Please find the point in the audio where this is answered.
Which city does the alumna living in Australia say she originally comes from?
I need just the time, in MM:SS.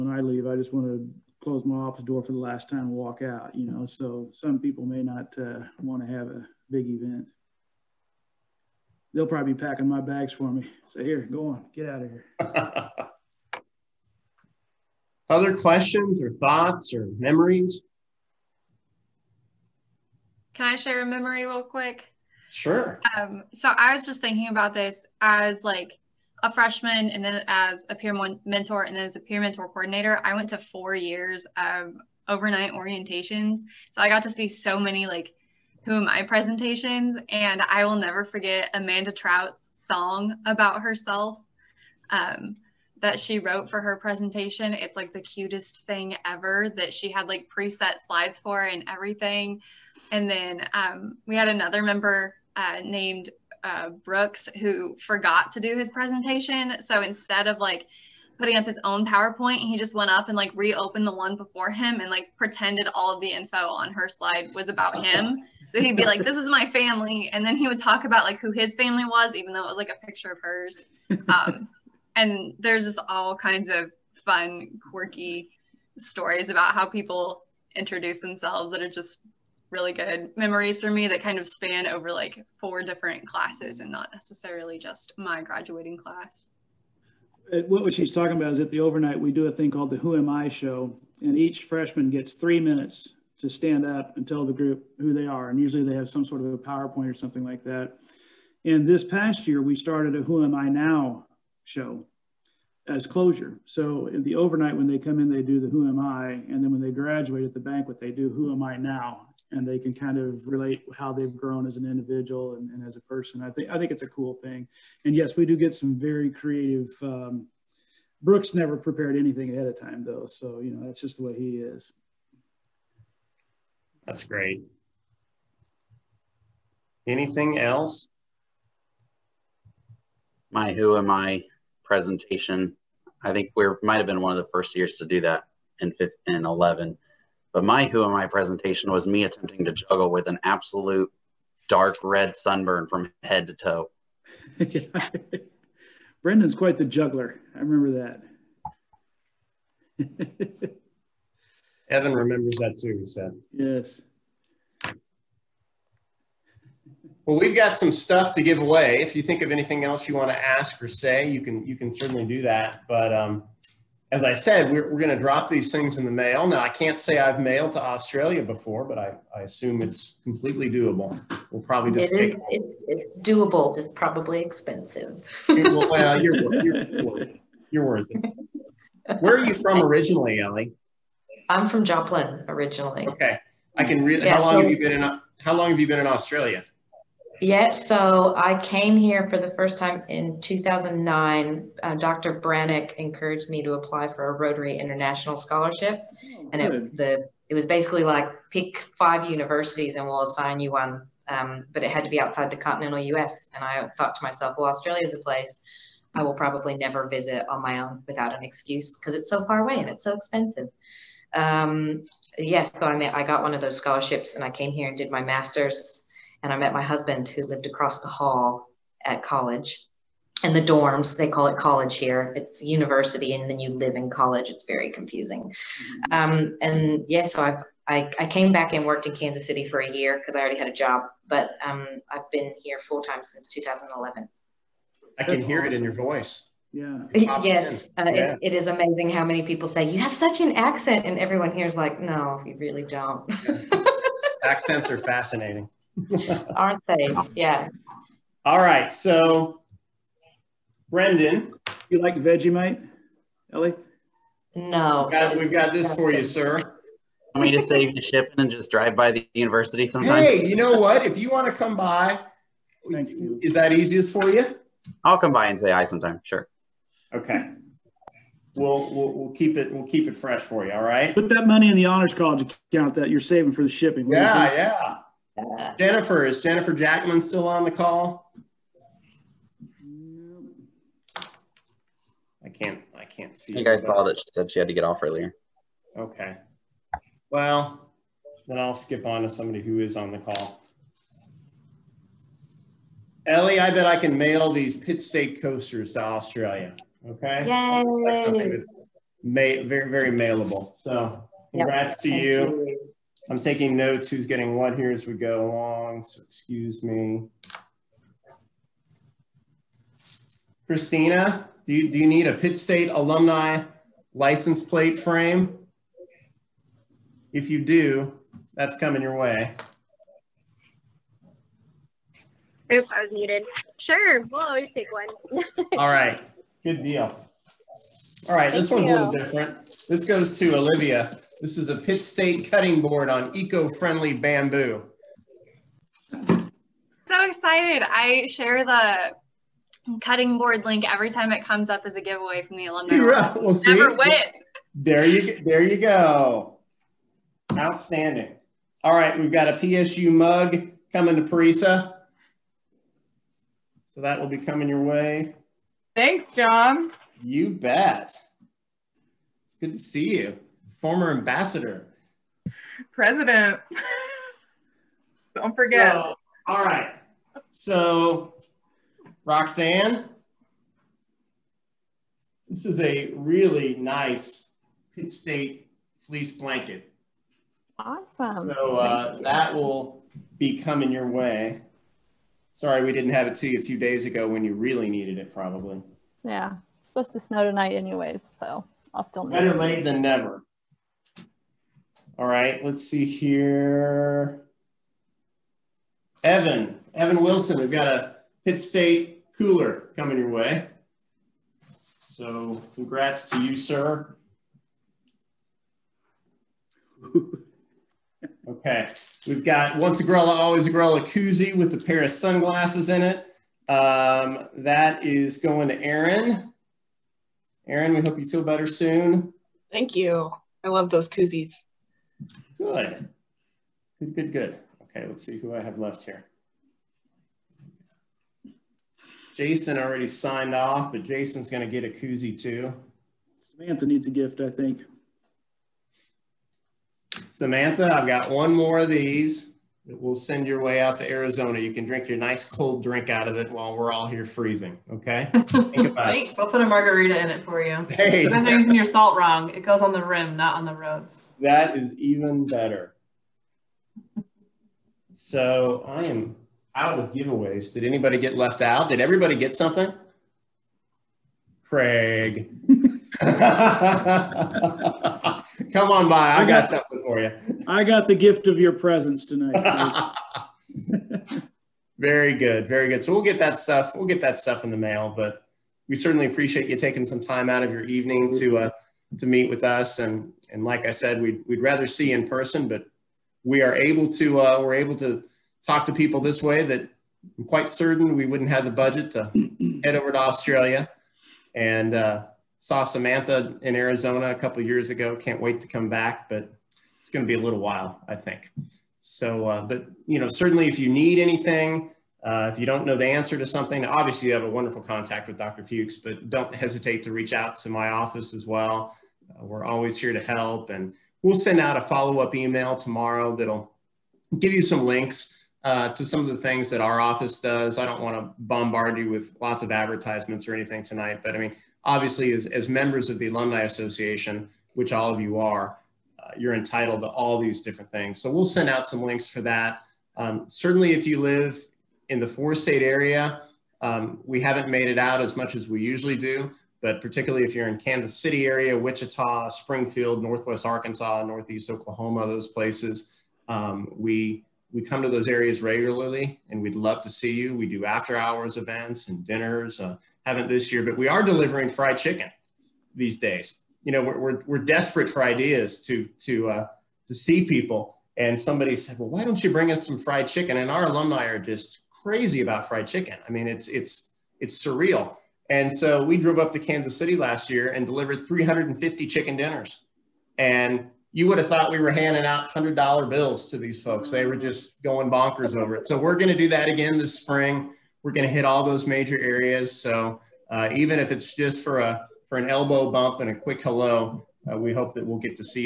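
03:01.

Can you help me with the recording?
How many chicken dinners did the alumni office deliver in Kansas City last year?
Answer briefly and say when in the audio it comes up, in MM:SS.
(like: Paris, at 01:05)
350, at 09:28.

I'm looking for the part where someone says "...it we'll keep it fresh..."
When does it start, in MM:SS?
04:29.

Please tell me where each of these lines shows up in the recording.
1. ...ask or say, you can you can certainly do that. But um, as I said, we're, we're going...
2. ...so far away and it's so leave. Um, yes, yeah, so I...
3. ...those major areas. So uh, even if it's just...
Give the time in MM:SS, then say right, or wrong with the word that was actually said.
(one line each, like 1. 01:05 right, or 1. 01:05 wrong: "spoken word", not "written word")
1. 02:40 right
2. 03:29 wrong: "expensive", not "leave"
3. 09:38 right.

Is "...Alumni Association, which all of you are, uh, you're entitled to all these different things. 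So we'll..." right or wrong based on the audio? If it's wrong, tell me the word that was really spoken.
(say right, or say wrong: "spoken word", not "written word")
right.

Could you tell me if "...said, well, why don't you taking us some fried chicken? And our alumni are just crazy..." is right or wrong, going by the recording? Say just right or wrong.
wrong.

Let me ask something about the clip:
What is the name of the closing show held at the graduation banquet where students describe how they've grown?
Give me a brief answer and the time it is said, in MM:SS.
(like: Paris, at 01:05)
Who Am I Now show, at 01:40.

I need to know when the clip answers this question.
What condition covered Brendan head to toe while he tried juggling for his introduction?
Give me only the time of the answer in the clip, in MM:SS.
02:21.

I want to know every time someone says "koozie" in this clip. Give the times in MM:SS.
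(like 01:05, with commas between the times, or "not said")
06:51, 07:01, 07:11.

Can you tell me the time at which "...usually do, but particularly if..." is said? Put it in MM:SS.
08:55.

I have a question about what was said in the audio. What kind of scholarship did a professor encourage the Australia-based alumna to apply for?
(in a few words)
Rotary International Scholarship.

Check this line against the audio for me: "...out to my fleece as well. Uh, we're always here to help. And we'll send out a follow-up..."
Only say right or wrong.
wrong.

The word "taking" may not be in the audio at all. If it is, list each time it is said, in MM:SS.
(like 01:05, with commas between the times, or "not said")
05:03, 07:56.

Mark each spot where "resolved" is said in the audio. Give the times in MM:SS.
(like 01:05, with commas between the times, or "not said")
not said.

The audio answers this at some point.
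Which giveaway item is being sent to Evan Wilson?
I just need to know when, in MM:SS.
06:38.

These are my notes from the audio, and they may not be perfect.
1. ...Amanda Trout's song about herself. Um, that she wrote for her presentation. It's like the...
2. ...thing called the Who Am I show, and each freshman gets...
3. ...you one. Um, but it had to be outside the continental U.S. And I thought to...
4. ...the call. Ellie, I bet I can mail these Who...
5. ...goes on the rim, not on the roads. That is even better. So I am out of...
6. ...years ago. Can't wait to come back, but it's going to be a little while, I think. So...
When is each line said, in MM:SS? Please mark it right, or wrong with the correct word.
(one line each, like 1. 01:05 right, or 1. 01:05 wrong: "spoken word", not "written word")
1. 00:38 right
2. 01:29 right
3. 03:20 right
4. 04:50 wrong: "Pitt", not "Who"
5. 07:29 right
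6. 08:14 right.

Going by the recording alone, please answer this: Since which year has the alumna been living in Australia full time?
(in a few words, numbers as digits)
2011.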